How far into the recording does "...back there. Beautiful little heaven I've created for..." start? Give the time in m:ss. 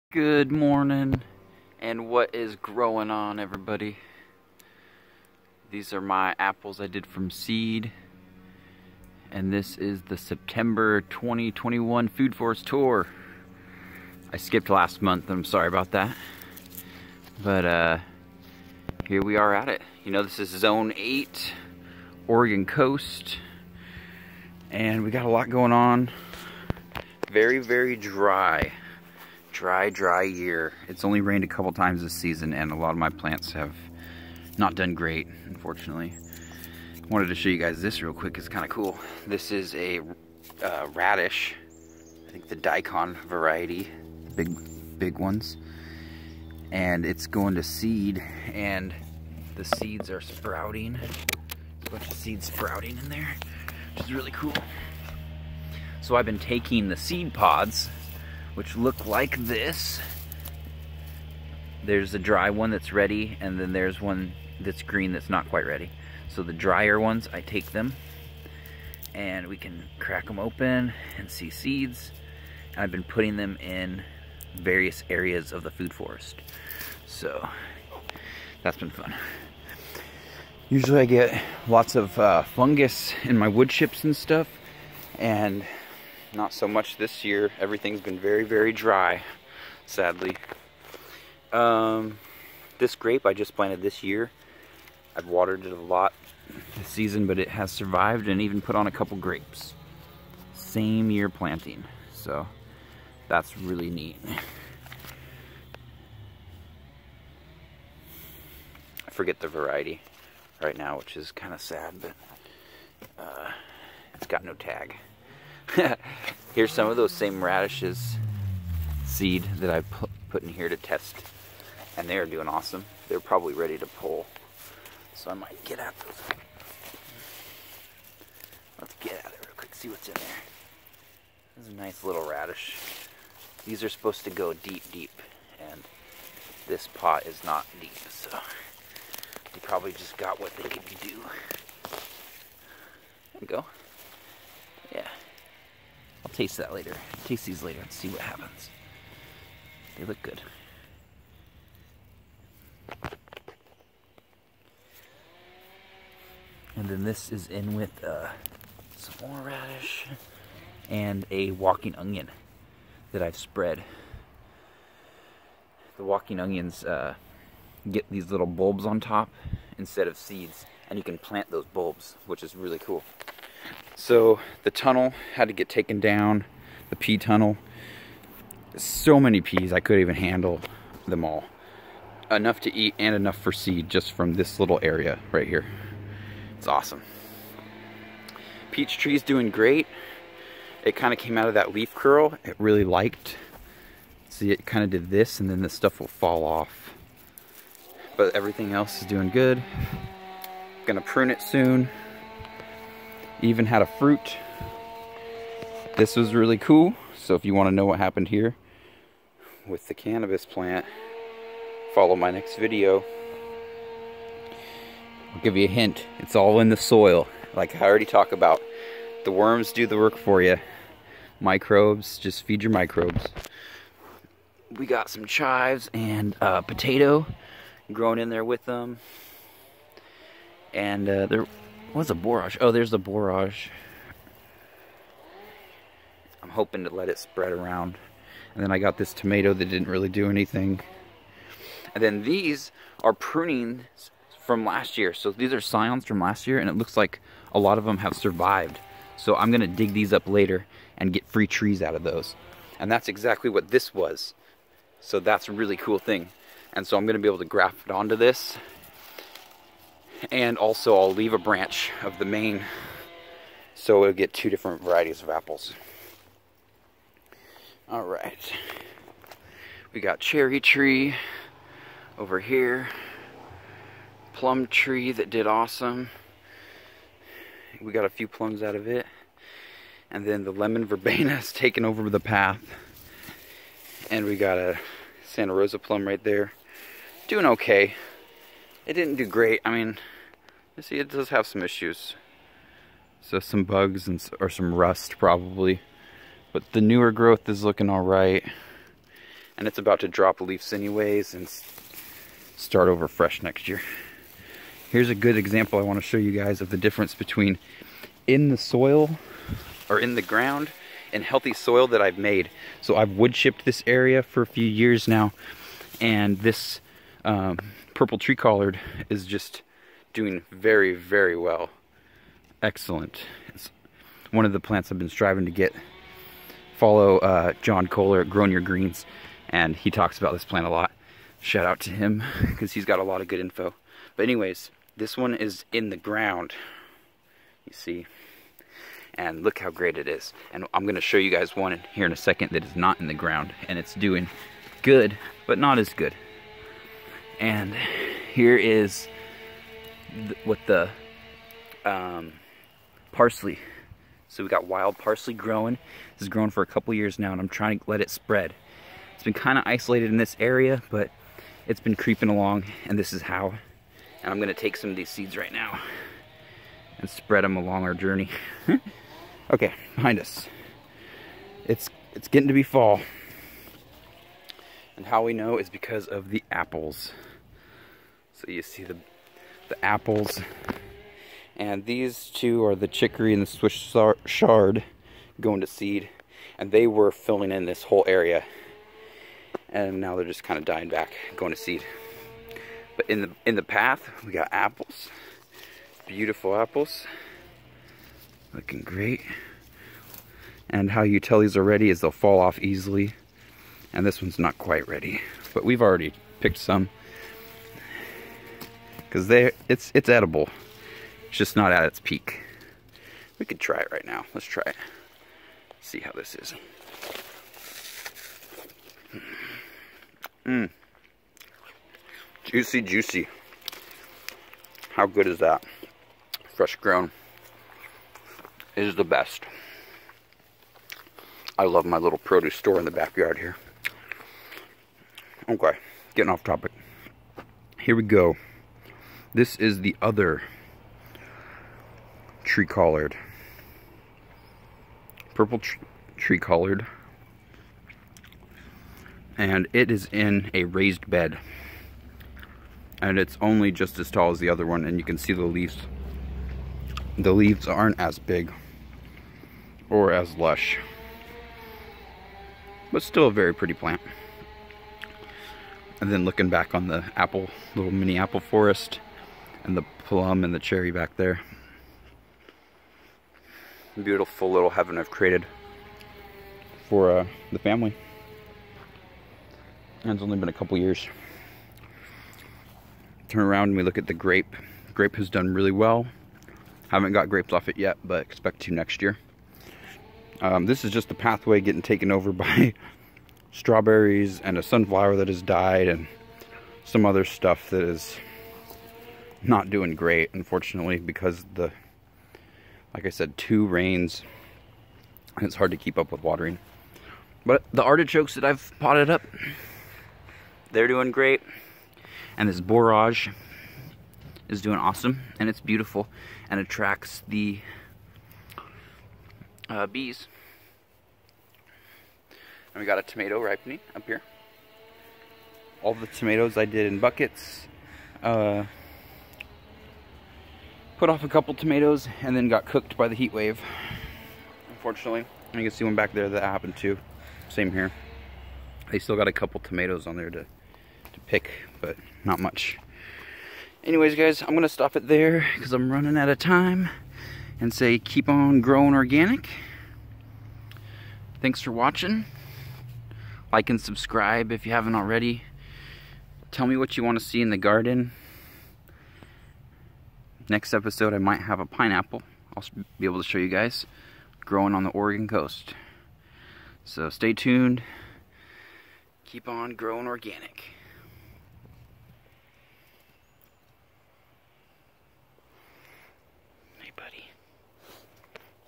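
7:50.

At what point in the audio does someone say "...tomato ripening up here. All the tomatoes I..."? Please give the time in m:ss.
8:43.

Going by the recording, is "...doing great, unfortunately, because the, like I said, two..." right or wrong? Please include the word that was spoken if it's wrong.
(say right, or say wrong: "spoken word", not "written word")
right.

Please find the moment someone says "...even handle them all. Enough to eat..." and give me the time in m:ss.
3:00.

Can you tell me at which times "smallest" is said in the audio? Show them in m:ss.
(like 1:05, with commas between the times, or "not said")
not said.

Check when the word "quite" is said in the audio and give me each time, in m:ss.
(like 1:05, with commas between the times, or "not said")
1:05, 6:44.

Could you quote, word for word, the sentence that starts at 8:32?
And this borage is doing awesome, and it's beautiful, and attracts the uh, bees.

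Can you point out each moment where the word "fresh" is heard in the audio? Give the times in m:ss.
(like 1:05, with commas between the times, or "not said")
5:03, 7:06.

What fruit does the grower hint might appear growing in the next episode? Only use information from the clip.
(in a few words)
pineapple.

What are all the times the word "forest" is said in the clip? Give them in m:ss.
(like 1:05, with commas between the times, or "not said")
0:12, 1:15, 7:48.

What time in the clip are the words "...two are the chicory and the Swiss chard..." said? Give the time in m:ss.
6:22.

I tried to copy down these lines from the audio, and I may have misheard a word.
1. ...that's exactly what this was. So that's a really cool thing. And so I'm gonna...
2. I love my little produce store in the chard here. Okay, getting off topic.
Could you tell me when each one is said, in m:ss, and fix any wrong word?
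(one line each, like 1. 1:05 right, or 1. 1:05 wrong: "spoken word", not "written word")
1. 4:12 right
2. 7:11 wrong: "backyard", not "chard".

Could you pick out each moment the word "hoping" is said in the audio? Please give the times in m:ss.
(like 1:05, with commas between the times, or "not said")
3:56.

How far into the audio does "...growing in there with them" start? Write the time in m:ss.
3:47.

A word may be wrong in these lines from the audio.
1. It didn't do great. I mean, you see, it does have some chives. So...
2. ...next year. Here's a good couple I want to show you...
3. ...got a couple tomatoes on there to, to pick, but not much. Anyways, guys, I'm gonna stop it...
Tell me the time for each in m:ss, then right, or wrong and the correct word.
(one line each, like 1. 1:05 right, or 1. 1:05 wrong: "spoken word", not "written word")
1. 4:48 wrong: "issues", not "chives"
2. 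5:03 wrong: "example", not "couple"
3. 8:59 right.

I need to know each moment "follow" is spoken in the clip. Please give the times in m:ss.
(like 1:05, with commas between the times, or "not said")
3:31, 5:26.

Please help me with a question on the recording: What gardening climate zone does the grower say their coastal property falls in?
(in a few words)
Zone 8.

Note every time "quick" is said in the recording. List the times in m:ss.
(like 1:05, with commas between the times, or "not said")
0:38, 2:09.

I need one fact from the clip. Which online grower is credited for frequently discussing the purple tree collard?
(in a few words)
John Kohler.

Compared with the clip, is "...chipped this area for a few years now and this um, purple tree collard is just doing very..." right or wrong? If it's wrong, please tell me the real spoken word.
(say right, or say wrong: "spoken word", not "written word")
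right.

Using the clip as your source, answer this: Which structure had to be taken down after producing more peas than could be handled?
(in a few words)
the pea tunnel.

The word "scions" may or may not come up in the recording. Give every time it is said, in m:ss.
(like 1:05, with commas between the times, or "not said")
4:05.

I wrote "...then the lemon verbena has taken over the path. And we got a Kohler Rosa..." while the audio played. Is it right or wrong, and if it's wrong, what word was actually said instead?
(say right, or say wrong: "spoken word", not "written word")
wrong: "Santa", not "Kohler".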